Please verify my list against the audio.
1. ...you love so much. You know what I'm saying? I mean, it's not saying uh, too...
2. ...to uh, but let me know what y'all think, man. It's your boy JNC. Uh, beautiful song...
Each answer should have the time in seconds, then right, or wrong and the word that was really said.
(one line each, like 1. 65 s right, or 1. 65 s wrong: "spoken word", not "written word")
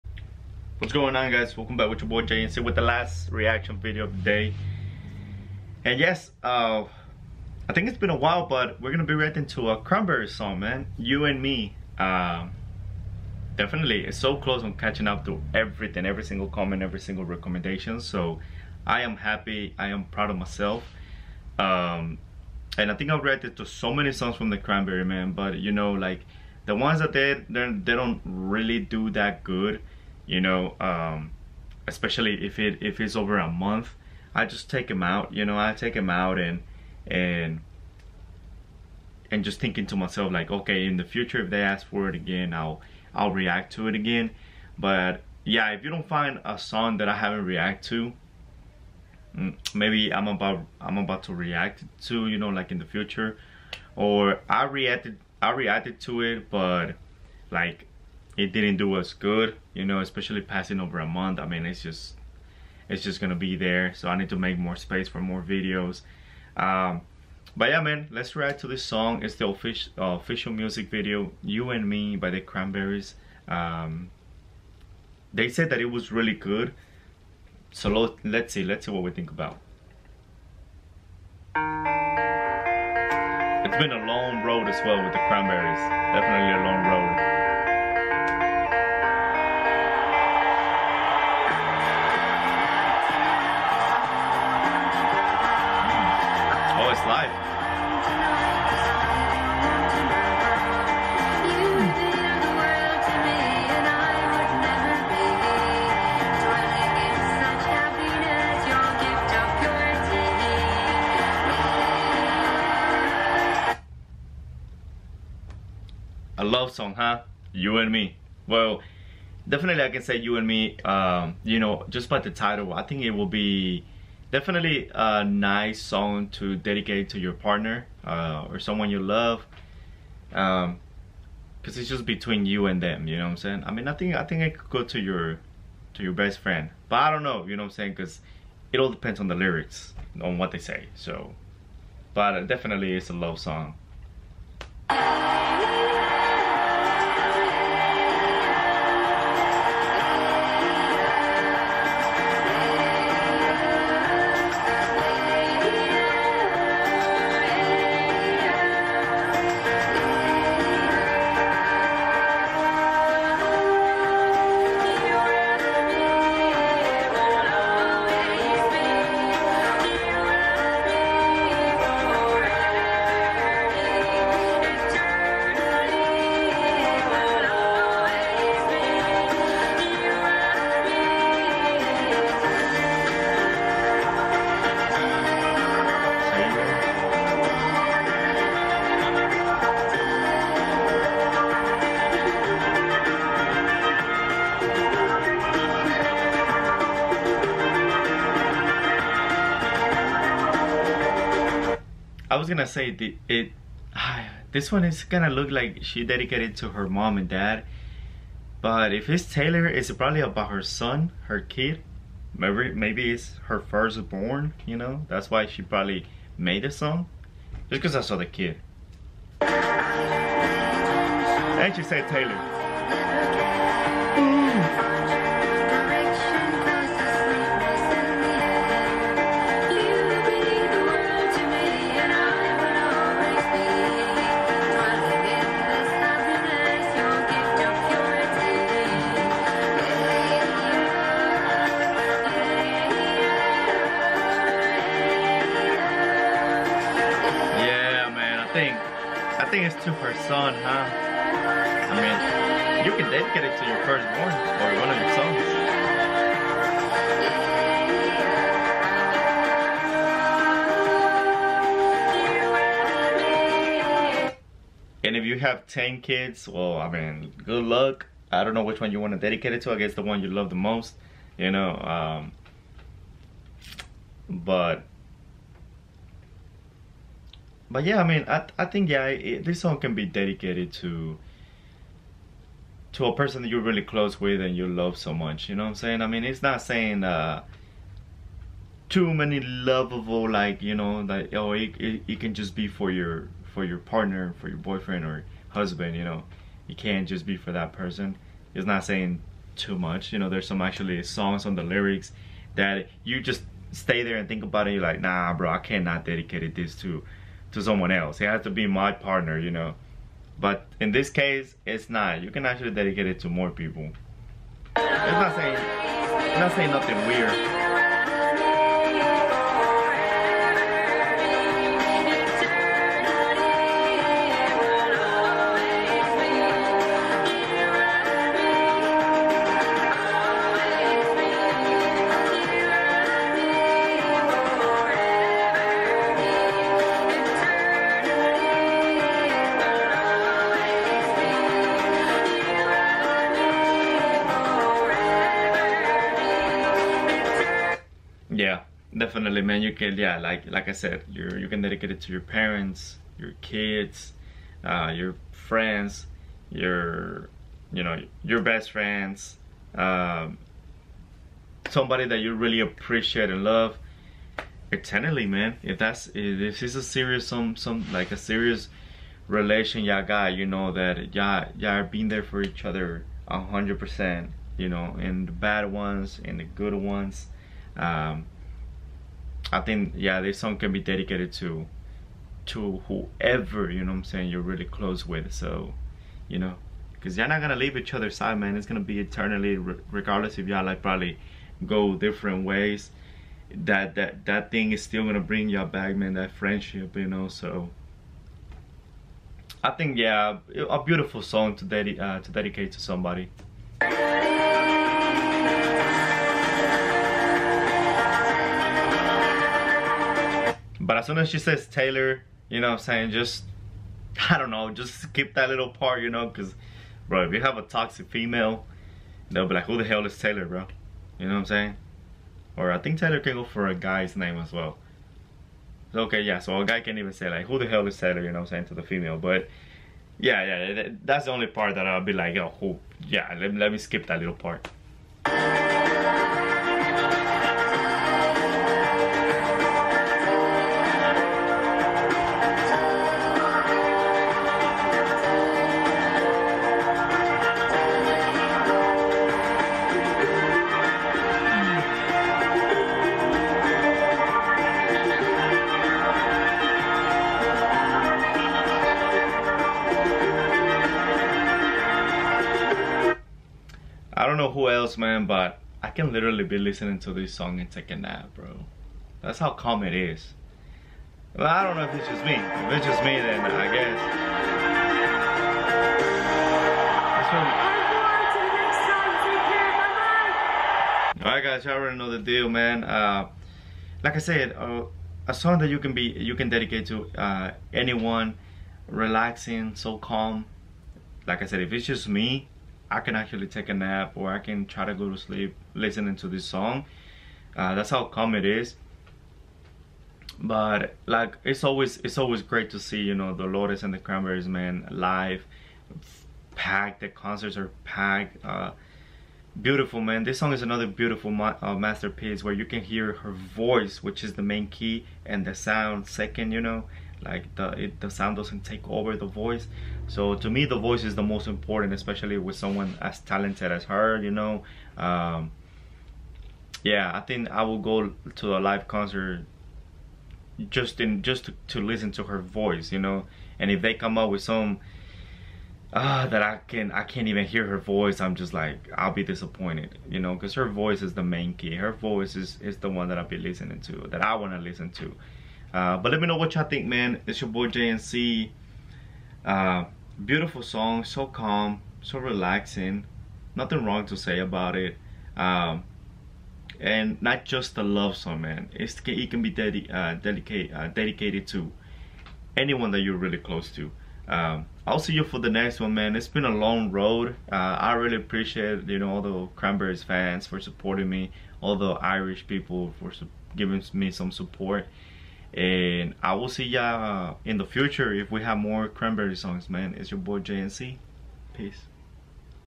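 1. 284 s right
2. 544 s right.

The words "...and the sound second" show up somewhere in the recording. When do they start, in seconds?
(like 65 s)
515 s.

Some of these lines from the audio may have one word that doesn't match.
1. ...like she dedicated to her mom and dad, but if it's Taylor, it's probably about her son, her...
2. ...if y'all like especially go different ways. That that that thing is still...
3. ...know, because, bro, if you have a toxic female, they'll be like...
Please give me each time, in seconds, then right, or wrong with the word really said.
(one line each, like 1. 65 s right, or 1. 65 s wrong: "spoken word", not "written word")
1. 205 s right
2. 390 s wrong: "probably", not "especially"
3. 416 s right.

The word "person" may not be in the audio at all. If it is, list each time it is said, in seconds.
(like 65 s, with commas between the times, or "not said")
283 s, 297 s.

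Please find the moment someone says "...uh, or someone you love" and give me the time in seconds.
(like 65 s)
128 s.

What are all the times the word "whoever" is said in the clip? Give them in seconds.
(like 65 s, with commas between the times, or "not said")
382 s.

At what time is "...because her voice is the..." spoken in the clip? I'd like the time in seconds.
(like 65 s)
540 s.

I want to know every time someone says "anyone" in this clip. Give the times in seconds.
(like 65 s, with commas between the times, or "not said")
487 s, 562 s.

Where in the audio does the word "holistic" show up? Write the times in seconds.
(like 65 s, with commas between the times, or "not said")
not said.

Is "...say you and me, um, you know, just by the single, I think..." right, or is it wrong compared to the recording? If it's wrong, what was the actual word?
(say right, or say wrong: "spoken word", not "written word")
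wrong: "title", not "single".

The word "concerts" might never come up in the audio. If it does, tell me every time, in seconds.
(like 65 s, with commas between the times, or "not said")
507 s, 528 s.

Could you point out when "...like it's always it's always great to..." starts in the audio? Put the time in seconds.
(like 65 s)
501 s.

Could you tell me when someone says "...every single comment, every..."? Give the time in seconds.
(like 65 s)
16 s.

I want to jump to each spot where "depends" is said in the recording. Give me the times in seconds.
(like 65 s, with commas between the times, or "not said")
138 s.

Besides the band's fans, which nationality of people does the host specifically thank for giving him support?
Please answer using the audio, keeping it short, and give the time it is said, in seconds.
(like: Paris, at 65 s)
Irish, at 571 s.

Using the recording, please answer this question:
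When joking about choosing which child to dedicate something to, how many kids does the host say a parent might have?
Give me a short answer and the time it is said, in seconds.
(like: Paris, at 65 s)
10, at 265 s.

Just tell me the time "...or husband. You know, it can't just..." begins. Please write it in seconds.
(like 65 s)
295 s.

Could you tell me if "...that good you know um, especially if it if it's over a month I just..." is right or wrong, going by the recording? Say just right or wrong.
right.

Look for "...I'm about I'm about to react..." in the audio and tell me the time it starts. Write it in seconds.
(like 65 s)
50 s.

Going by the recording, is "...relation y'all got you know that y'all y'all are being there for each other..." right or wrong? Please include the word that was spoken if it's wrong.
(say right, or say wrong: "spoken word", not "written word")
right.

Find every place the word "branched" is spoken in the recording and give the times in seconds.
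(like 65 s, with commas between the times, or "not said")
not said.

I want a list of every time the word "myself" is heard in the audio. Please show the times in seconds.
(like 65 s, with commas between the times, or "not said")
20 s, 39 s.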